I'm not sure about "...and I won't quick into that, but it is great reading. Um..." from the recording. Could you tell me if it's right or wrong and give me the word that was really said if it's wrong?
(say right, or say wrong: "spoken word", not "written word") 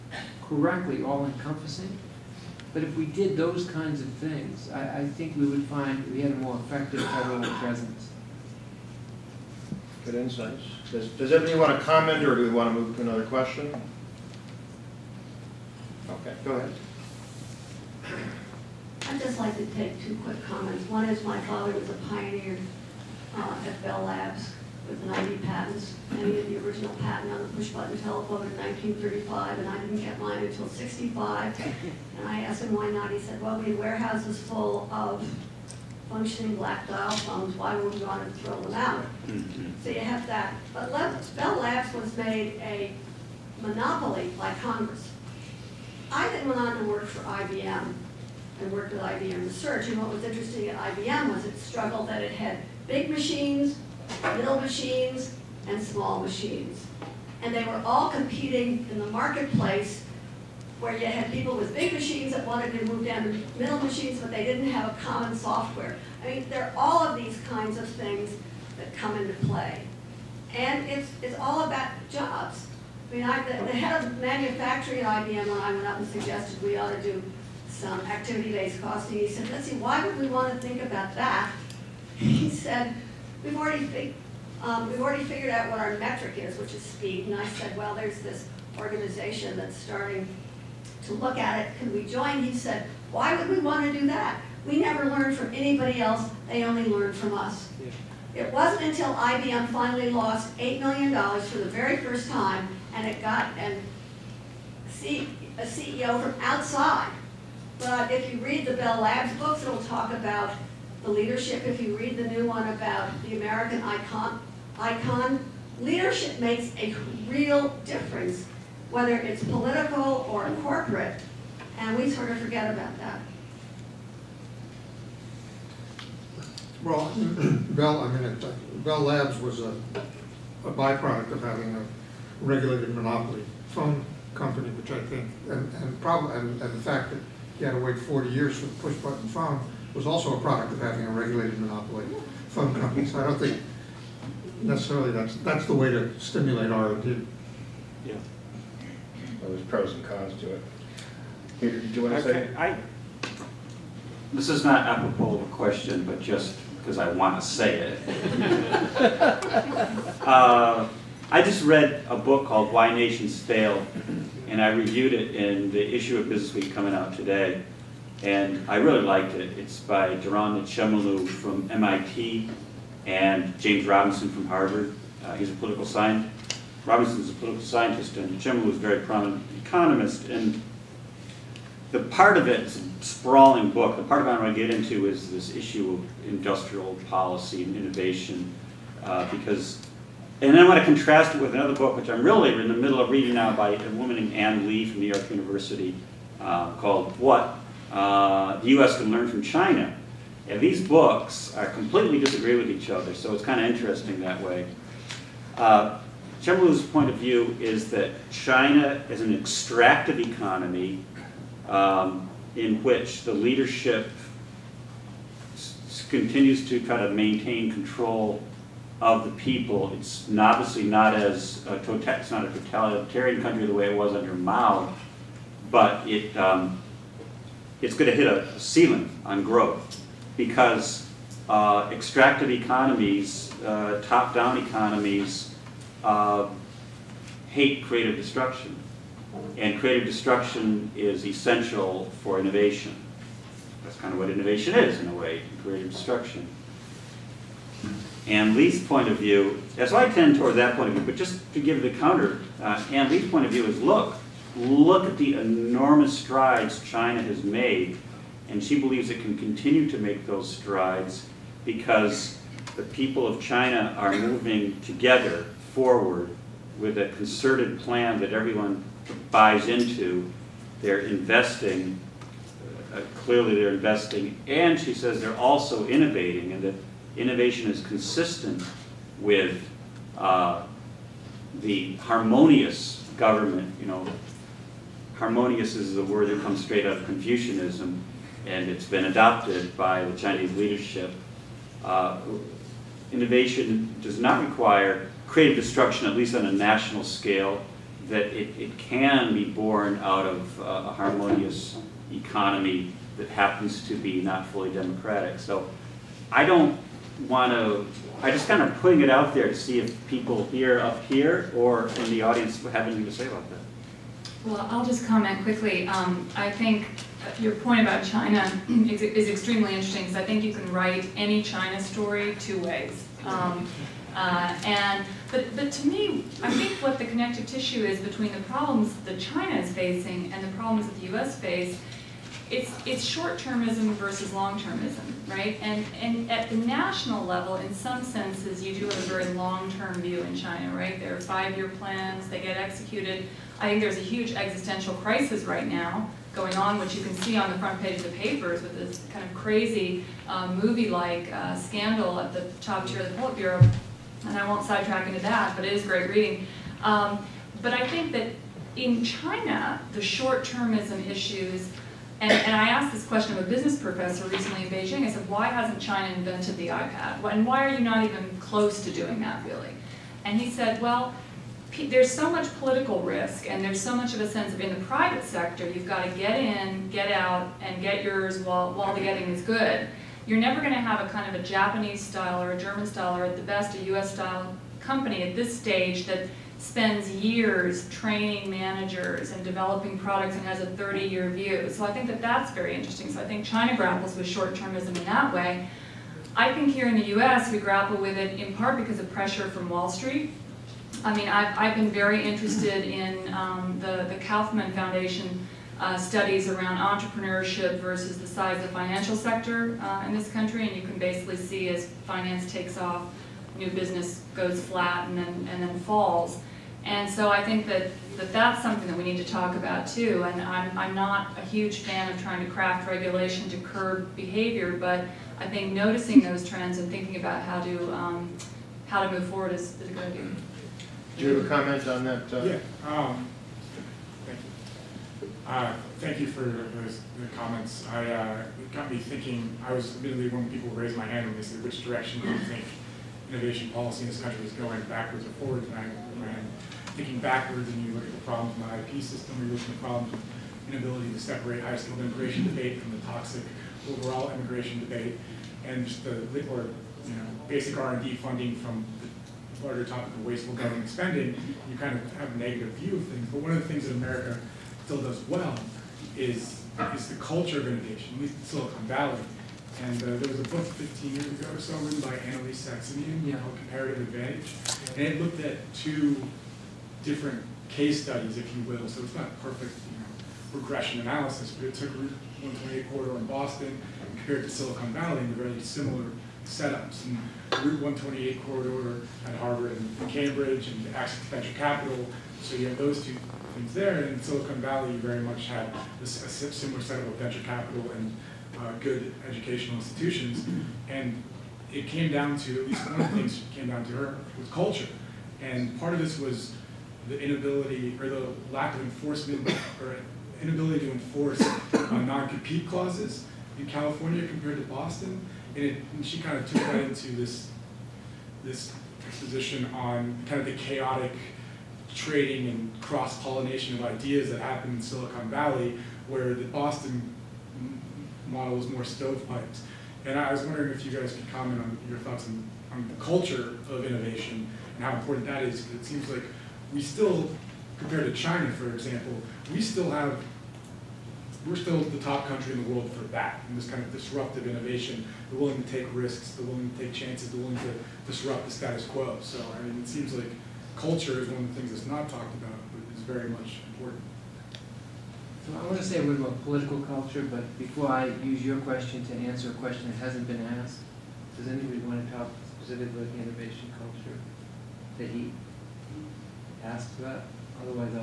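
wrong: "sidetrack", not "quick".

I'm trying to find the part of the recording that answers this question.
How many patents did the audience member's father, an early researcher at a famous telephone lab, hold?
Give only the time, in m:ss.
0:25.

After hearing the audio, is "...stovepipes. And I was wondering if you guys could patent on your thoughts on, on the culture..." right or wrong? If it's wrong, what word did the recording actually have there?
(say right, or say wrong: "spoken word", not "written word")
wrong: "comment", not "patent".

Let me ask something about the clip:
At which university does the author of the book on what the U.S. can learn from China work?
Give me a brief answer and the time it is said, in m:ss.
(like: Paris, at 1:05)
New York University, at 3:15.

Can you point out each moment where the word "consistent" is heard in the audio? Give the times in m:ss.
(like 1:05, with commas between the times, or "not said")
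4:37.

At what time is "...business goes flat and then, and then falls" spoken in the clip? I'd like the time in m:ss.
6:53.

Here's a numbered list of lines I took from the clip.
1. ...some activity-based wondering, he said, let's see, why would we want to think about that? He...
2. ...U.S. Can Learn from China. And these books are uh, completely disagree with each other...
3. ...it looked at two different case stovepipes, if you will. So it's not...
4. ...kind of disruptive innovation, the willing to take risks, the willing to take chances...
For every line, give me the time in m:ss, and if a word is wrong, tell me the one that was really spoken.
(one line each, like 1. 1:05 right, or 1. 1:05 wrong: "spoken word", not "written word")
1. 1:17 wrong: "costing", not "wondering"
2. 3:18 right
3. 7:55 wrong: "studies", not "stovepipes"
4. 9:03 right.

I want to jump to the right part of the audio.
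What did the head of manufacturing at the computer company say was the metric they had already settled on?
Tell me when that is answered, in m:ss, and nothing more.
1:26.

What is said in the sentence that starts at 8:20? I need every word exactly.
And it came down to, at least one of the things came down to her, was culture.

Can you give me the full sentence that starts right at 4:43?
You know, harmonious is the word that comes straight out of Confucianism, and it's been adopted by the Chinese leadership.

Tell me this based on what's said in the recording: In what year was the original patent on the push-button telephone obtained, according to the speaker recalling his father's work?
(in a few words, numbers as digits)
1935.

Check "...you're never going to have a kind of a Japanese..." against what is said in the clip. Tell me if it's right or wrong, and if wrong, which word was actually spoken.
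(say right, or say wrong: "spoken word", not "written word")
right.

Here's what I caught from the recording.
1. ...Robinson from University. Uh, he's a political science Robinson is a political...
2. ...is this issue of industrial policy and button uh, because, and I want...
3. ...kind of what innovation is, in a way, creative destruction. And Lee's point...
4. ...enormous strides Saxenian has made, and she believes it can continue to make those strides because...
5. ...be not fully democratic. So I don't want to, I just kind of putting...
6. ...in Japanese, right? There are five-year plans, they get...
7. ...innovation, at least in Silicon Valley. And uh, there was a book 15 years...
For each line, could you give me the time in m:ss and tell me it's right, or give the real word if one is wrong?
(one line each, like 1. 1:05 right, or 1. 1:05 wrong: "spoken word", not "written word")
1. 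2:53 wrong: "Harvard", not "University"
2. 3:05 wrong: "innovation", not "button"
3. 4:03 right
4. 4:15 wrong: "China", not "Saxenian"
5. 5:03 right
6. 5:40 wrong: "China", not "Japanese"
7. 7:47 right.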